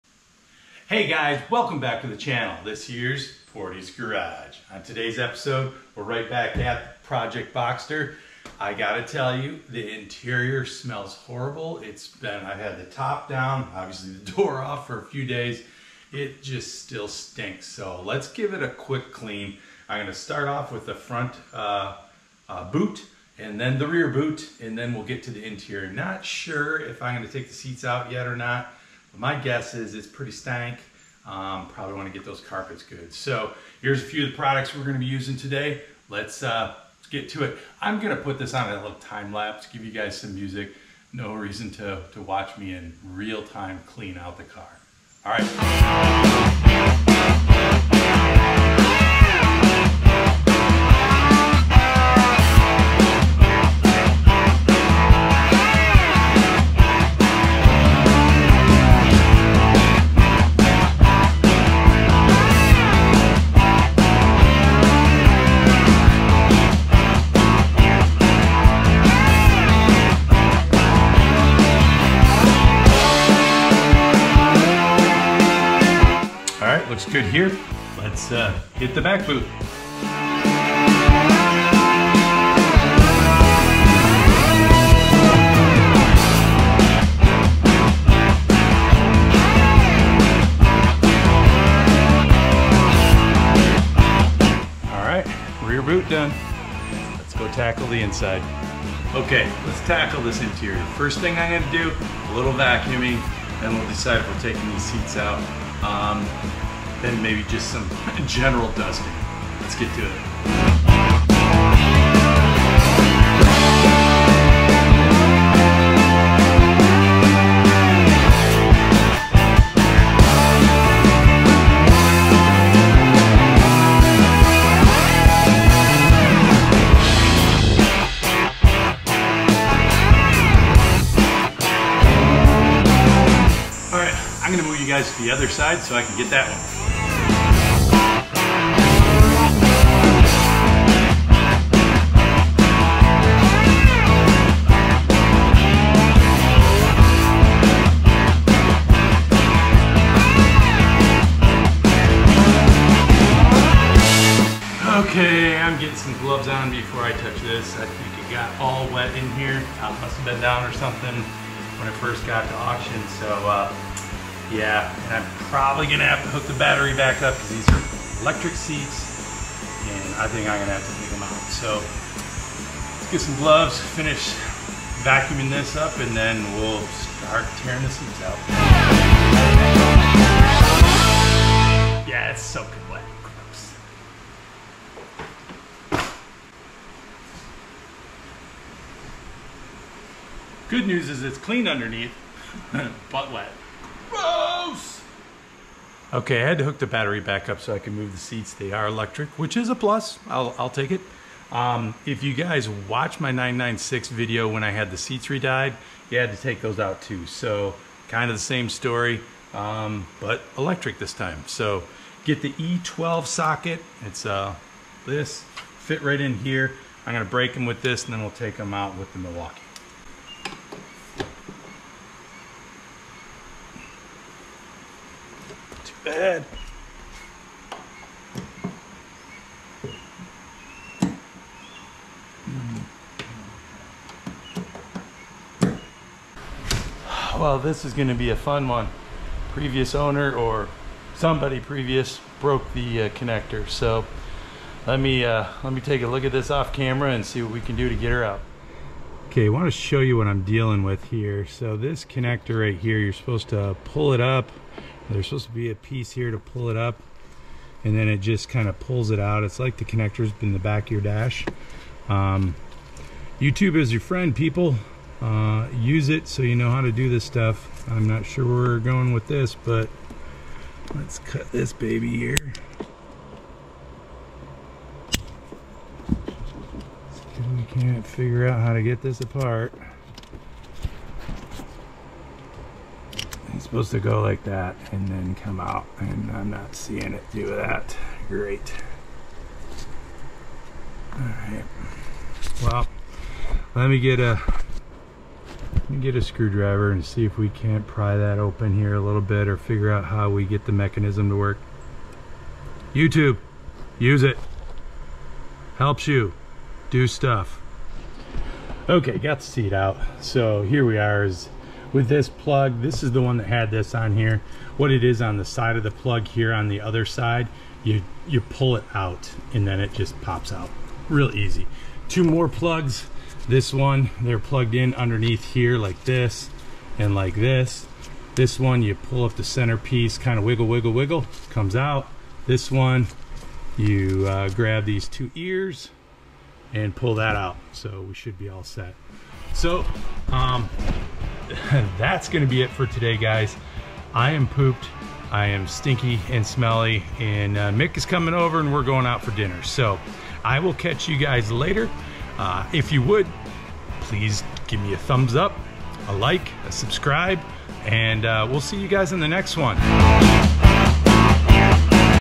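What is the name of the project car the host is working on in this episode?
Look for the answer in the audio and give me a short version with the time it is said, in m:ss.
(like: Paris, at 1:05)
Project Boxster, at 0:07.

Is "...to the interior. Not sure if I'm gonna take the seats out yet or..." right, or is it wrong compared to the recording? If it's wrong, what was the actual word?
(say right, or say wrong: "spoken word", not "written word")
right.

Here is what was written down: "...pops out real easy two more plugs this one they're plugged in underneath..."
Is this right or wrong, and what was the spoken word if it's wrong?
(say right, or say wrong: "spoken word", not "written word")
right.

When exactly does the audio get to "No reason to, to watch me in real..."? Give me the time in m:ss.
0:41.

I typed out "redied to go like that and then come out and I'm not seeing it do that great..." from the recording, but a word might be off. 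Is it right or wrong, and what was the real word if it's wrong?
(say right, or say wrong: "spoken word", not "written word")
wrong: "supposed", not "redied".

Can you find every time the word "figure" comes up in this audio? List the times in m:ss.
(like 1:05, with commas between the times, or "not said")
4:38, 4:59.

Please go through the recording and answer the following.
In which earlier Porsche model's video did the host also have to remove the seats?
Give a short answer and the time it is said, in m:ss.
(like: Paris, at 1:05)
996, at 3:23.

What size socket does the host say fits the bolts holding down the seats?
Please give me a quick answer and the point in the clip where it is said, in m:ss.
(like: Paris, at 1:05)
E12, at 3:32.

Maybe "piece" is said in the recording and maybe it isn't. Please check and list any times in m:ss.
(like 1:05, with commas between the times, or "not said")
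4:15, 5:29.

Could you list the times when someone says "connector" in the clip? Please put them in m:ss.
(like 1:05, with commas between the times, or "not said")
4:03, 4:12, 4:19.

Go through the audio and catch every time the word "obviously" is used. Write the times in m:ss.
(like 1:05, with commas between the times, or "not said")
0:13.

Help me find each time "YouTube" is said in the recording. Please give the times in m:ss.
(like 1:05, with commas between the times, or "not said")
4:23, 5:02.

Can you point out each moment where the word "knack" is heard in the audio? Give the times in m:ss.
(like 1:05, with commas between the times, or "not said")
not said.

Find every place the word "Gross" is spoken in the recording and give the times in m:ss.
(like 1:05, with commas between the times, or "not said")
3:03, 3:14.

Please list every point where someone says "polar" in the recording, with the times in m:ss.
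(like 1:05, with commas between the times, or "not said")
not said.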